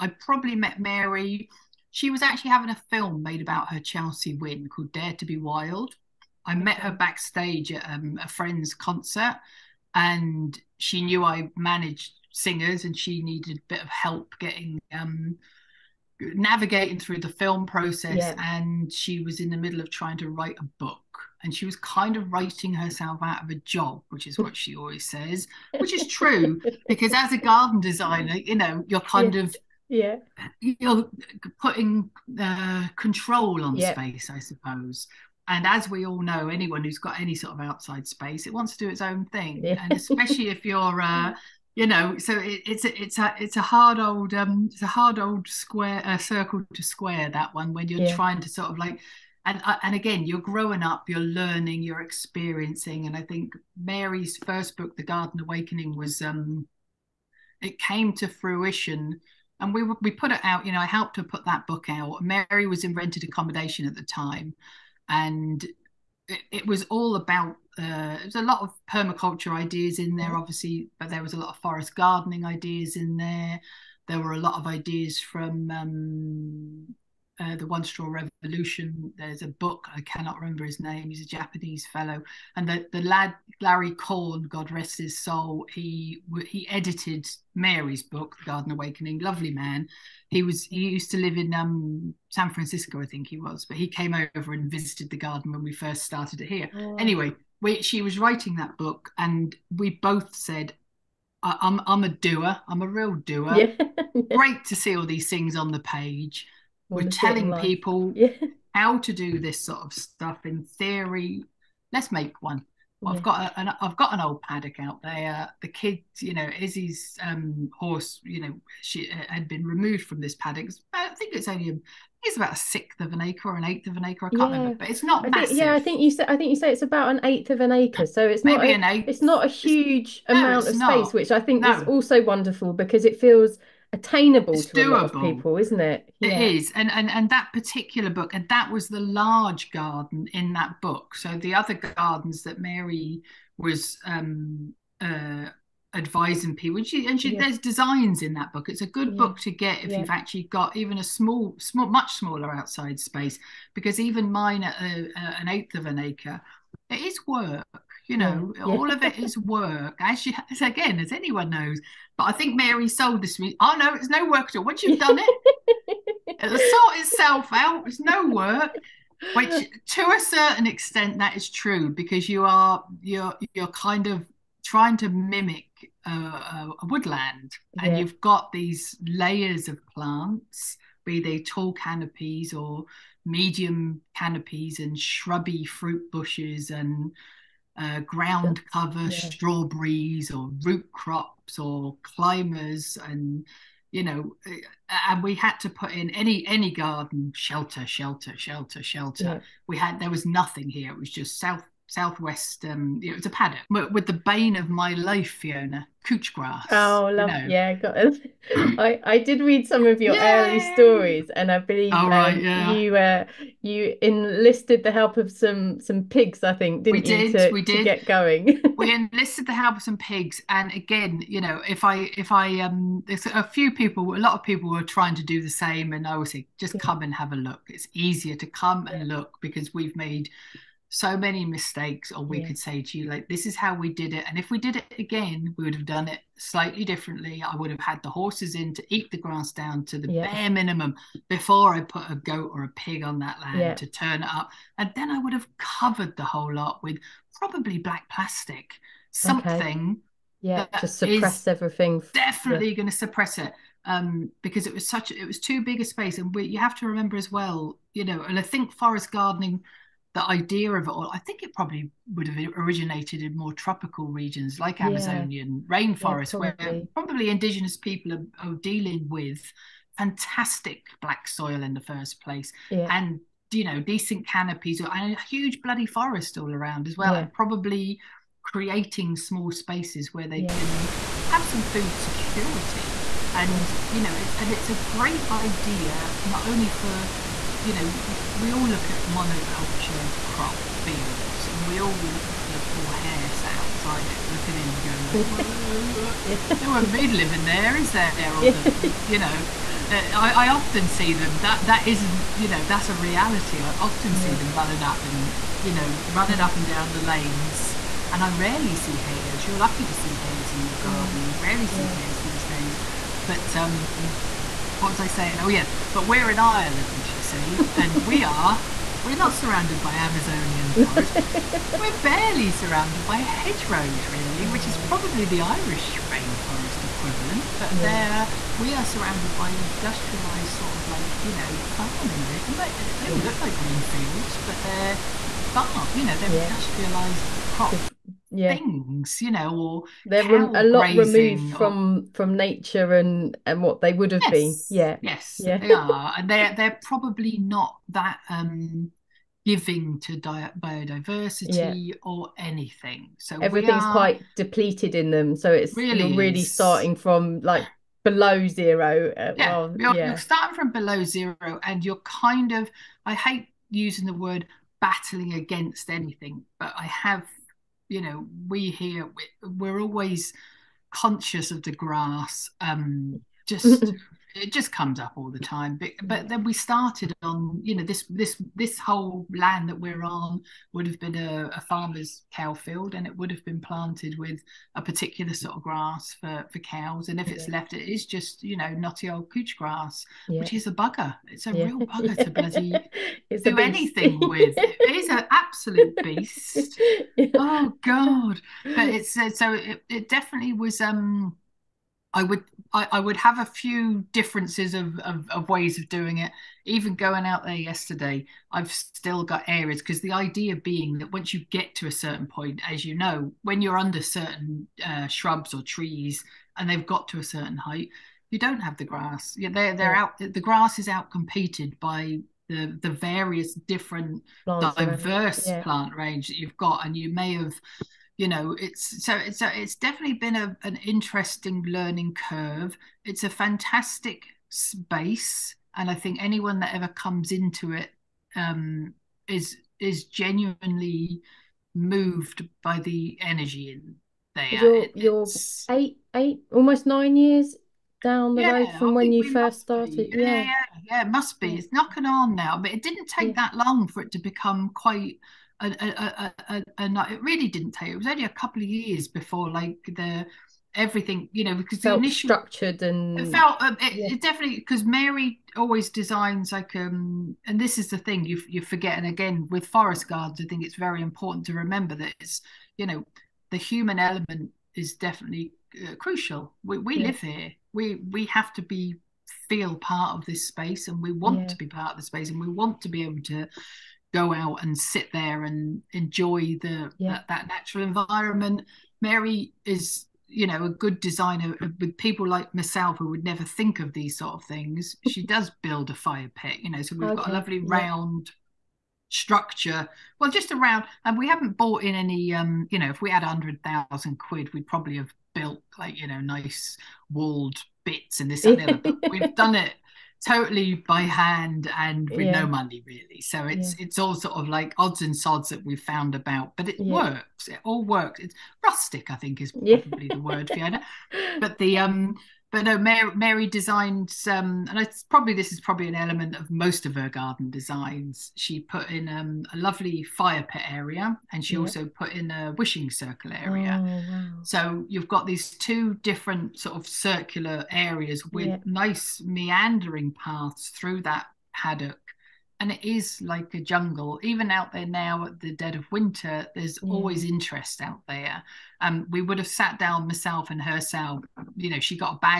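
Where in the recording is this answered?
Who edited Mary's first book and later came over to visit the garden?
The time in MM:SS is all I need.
01:23.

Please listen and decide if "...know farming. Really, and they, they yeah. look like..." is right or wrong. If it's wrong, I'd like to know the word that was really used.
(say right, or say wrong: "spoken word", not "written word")
right.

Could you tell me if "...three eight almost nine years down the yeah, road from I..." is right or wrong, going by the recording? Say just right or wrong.
wrong.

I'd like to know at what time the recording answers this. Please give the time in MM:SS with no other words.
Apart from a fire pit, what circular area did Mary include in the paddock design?
08:52.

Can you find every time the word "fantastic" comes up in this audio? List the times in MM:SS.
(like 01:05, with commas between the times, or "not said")
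04:29, 07:13.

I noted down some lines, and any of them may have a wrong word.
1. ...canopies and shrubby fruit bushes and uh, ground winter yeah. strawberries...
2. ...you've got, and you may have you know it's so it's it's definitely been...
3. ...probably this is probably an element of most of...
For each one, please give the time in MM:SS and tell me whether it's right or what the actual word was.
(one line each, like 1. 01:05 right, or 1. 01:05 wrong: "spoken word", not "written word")
1. 03:04 wrong: "cover", not "winter"
2. 07:06 right
3. 08:45 right.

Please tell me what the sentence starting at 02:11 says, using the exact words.
is also wonderful because it feels attainable it's to doable.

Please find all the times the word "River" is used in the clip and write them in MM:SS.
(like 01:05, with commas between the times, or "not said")
not said.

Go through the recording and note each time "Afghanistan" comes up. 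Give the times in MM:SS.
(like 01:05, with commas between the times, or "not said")
not said.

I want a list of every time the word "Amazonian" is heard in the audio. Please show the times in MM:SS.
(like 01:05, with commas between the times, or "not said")
04:24, 05:19.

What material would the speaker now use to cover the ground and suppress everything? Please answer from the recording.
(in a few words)
Black plastic.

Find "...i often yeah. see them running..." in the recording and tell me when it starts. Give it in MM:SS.
05:03.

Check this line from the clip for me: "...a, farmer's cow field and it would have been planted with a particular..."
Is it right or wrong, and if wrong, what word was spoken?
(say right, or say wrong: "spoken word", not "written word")
right.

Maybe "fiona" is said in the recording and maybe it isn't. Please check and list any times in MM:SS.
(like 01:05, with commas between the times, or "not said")
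03:25, 08:40.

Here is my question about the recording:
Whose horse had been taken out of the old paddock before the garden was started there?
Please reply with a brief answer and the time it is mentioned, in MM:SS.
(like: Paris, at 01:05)
Izzy, at 01:56.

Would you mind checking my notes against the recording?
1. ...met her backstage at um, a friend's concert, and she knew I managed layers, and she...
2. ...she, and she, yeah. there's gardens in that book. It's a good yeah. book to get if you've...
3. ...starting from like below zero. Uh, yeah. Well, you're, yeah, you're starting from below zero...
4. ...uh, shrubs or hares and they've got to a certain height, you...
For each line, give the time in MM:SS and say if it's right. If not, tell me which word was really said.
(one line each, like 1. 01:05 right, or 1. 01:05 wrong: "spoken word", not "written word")
1. 00:06 wrong: "singers", not "layers"
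2. 02:26 wrong: "designs", not "gardens"
3. 05:56 right
4. 06:54 wrong: "trees", not "hares".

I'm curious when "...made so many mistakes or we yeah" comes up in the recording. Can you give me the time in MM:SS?
03:49.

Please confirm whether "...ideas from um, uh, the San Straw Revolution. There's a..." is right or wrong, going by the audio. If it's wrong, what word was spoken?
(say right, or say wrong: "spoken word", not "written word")
wrong: "One", not "San".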